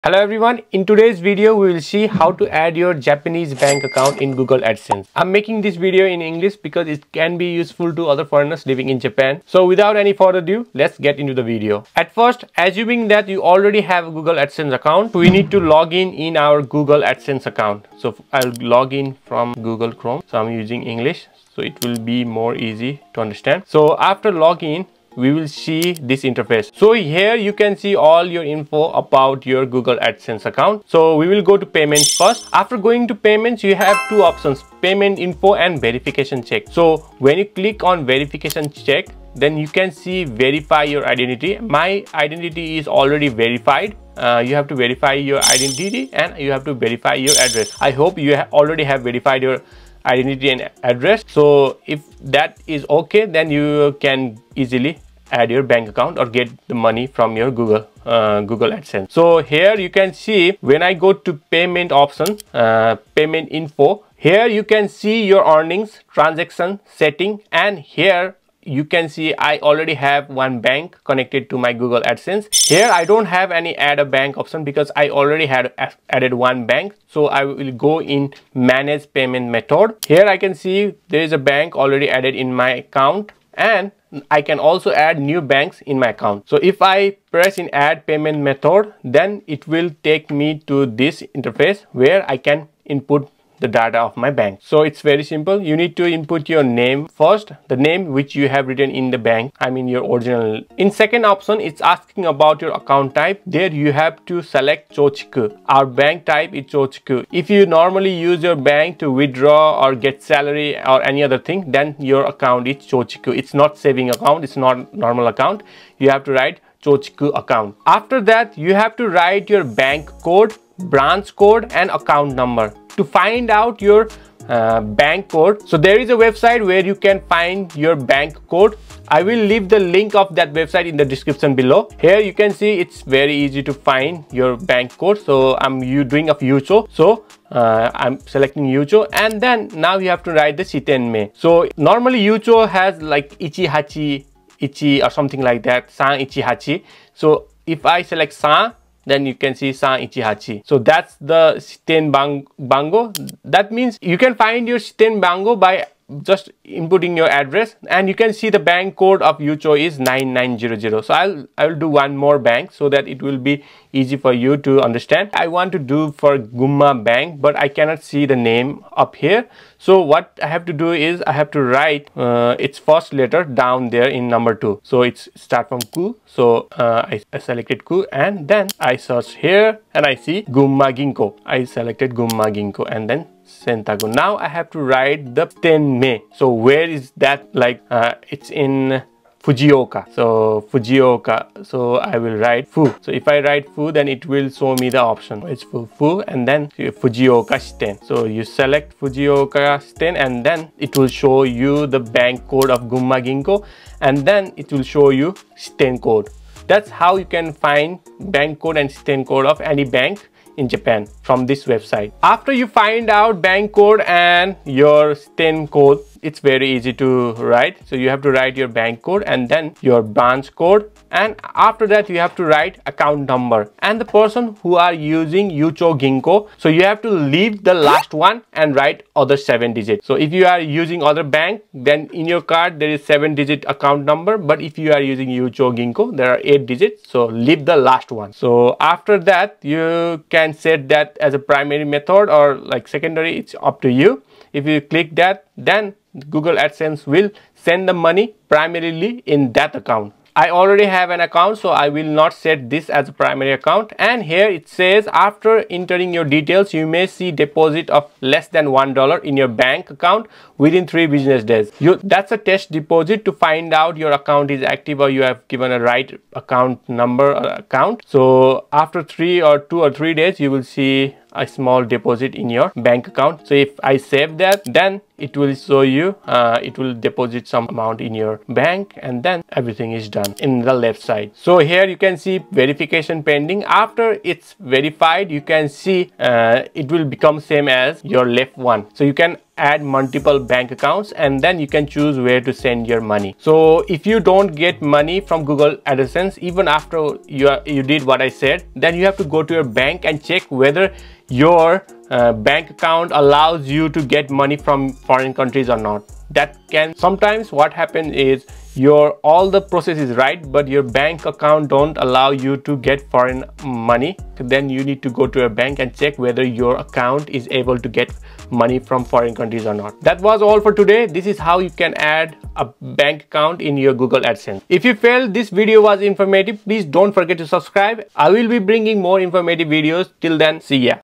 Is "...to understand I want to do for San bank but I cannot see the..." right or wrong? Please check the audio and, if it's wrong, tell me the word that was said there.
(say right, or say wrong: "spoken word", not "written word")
wrong: "Gumma", not "San".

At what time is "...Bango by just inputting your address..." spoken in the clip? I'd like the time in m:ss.
2:35.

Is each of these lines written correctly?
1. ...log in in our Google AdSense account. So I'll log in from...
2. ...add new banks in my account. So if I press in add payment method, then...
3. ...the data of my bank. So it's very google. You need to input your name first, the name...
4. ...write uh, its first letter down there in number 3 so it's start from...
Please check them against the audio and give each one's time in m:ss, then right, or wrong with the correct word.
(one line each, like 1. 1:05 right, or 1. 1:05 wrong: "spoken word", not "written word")
1. 0:15 right
2. 1:24 right
3. 1:33 wrong: "simple", not "google"
4. 2:51 wrong: "2", not "3".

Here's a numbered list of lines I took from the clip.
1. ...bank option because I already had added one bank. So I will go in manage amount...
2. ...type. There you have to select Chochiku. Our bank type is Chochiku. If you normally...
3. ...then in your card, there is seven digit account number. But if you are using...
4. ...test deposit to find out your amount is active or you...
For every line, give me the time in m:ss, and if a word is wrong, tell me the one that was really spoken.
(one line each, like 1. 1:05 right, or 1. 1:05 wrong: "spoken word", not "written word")
1. 1:14 wrong: "payment", not "amount"
2. 1:43 right
3. 3:51 right
4. 4:22 wrong: "account", not "amount".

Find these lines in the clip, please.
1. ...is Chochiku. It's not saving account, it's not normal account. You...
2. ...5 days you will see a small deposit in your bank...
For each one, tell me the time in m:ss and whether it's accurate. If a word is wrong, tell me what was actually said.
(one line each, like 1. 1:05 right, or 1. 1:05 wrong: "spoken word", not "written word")
1. 1:52 right
2. 4:29 wrong: "3", not "5".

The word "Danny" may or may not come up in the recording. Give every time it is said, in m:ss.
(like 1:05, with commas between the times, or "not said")
not said.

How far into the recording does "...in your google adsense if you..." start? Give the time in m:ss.
5:23.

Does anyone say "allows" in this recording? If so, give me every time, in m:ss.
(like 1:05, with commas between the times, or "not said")
5:03, 5:11.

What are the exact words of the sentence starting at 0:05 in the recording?
I'm making this video in English because it can be useful to other foreigners living in Japan.